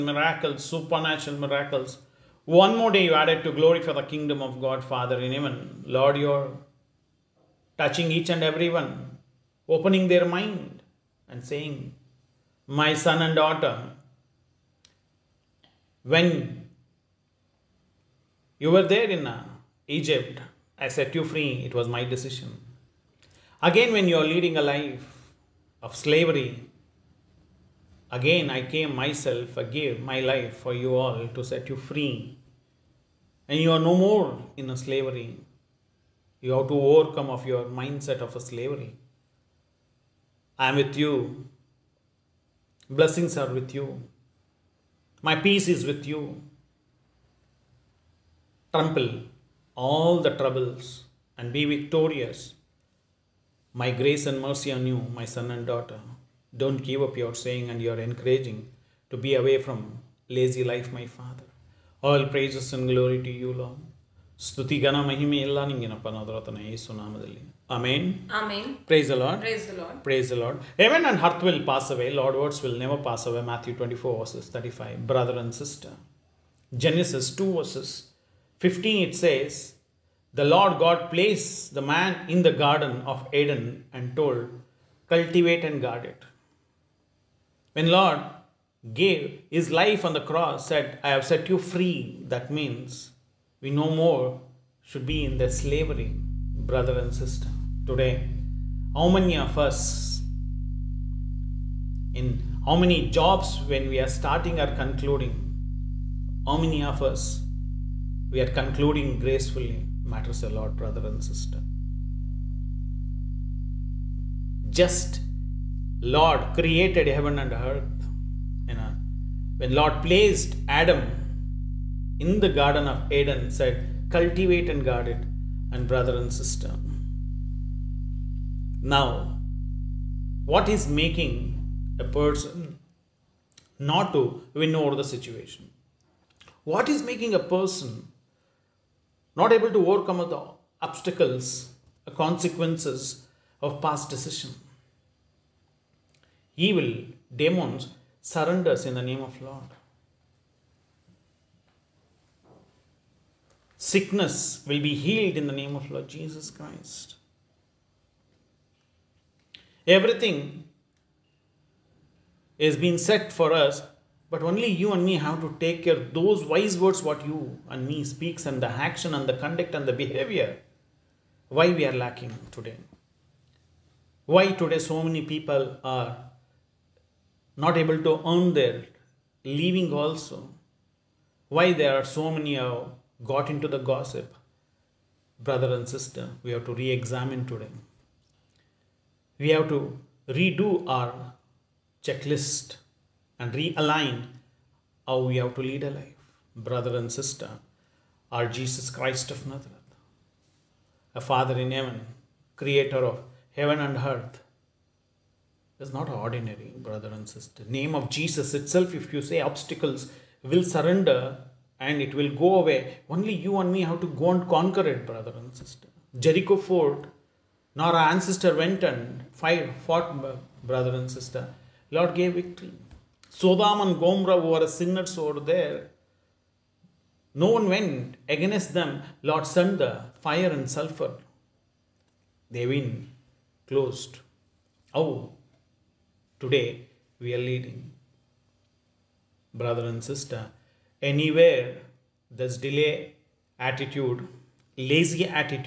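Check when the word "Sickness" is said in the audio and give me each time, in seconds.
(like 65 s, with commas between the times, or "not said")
153 s.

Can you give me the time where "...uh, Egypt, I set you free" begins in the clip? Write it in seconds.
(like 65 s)
19 s.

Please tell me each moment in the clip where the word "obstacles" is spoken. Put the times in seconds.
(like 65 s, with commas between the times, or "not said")
140 s, 209 s.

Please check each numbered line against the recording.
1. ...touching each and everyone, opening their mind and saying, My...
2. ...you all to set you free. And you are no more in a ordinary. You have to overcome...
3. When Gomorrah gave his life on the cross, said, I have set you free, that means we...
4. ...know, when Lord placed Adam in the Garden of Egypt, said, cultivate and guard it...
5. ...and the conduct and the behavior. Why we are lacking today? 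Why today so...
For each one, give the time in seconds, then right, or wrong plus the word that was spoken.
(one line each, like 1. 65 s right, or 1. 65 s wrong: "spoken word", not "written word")
1. 7 s right
2. 30 s wrong: "slavery", not "ordinary"
3. 87 s wrong: "Lord", not "Gomorrah"
4. 118 s wrong: "Eden", not "Egypt"
5. 169 s right.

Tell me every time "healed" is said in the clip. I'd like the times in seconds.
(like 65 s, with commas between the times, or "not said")
154 s.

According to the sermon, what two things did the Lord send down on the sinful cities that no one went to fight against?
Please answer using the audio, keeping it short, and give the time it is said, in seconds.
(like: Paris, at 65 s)
Fire and sulfur, at 230 s.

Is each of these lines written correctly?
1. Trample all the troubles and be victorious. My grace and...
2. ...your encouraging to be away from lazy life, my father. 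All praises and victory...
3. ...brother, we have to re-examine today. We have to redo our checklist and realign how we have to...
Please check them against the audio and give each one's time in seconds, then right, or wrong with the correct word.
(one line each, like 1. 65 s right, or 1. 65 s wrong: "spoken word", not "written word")
1. 48 s right
2. 57 s wrong: "glory", not "victory"
3. 185 s wrong: "sister", not "brother".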